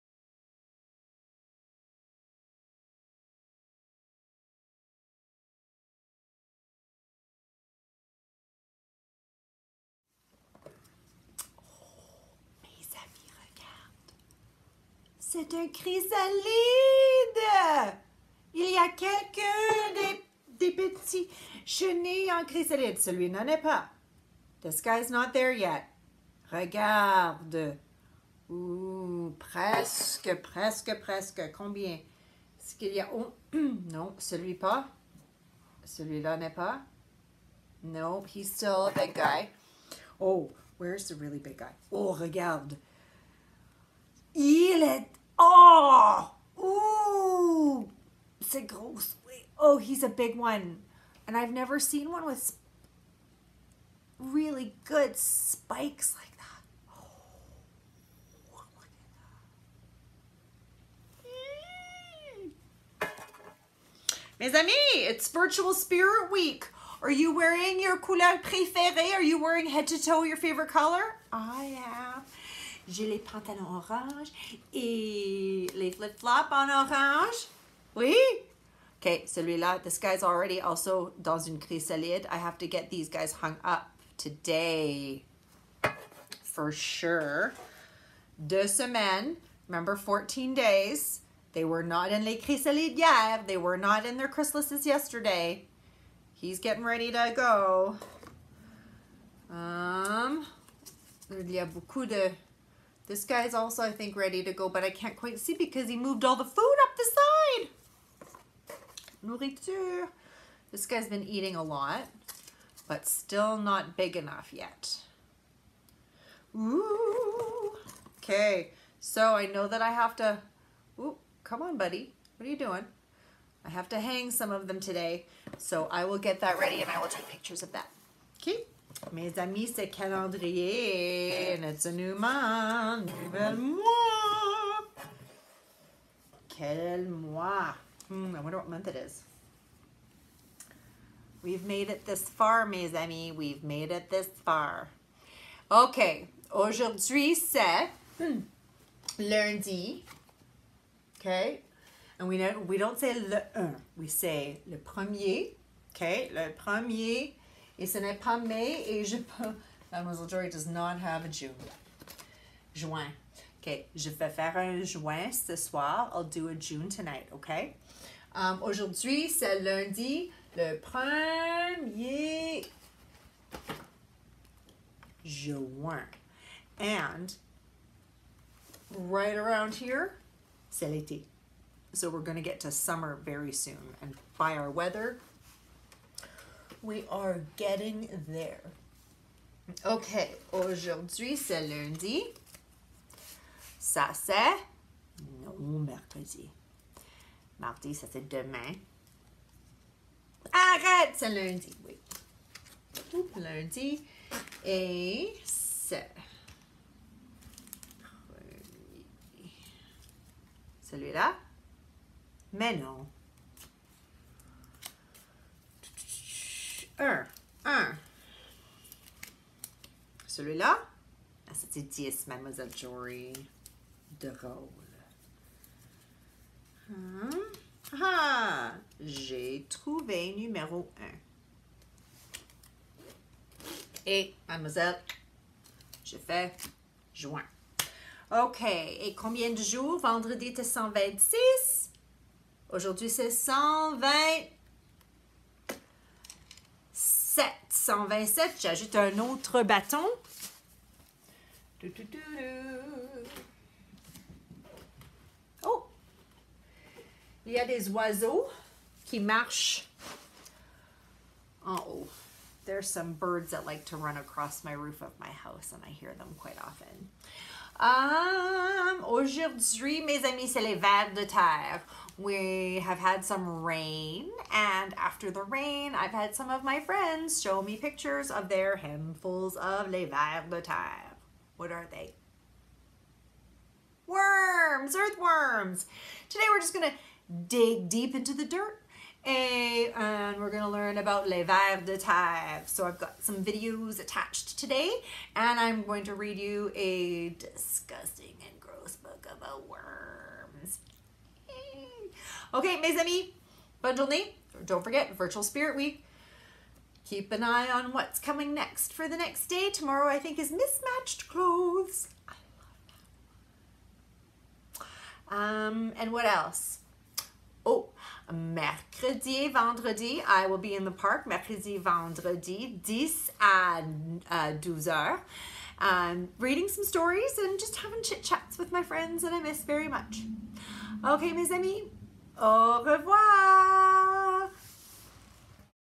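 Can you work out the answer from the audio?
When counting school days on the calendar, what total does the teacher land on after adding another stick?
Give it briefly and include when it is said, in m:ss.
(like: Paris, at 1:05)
127, at 4:07.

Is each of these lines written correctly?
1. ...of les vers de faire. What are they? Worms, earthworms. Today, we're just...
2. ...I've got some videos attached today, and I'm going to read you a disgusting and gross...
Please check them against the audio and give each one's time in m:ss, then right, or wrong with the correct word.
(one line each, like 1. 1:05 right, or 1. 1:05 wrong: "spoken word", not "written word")
1. 4:39 wrong: "terre", not "faire"
2. 4:52 right.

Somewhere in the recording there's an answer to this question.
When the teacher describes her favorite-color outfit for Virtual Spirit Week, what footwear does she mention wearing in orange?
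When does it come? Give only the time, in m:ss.
1:15.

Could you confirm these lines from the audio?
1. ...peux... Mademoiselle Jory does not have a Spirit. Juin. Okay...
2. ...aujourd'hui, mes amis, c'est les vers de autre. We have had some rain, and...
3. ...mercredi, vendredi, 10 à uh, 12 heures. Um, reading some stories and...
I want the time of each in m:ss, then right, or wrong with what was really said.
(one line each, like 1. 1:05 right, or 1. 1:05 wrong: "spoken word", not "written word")
1. 2:39 wrong: "June", not "Spirit"
2. 4:29 wrong: "terre", not "autre"
3. 5:21 right.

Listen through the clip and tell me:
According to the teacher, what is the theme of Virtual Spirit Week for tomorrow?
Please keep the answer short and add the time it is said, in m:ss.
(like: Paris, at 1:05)
mismatched clothes, at 5:10.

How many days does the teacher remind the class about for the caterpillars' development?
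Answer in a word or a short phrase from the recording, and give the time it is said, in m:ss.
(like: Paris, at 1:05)
14, at 1:29.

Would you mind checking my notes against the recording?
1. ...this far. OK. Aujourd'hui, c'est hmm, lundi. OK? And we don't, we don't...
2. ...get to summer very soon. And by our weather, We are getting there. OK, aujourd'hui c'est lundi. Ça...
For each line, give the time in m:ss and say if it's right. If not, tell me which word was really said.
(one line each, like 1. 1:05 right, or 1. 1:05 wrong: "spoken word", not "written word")
1. 2:24 right
2. 3:02 right.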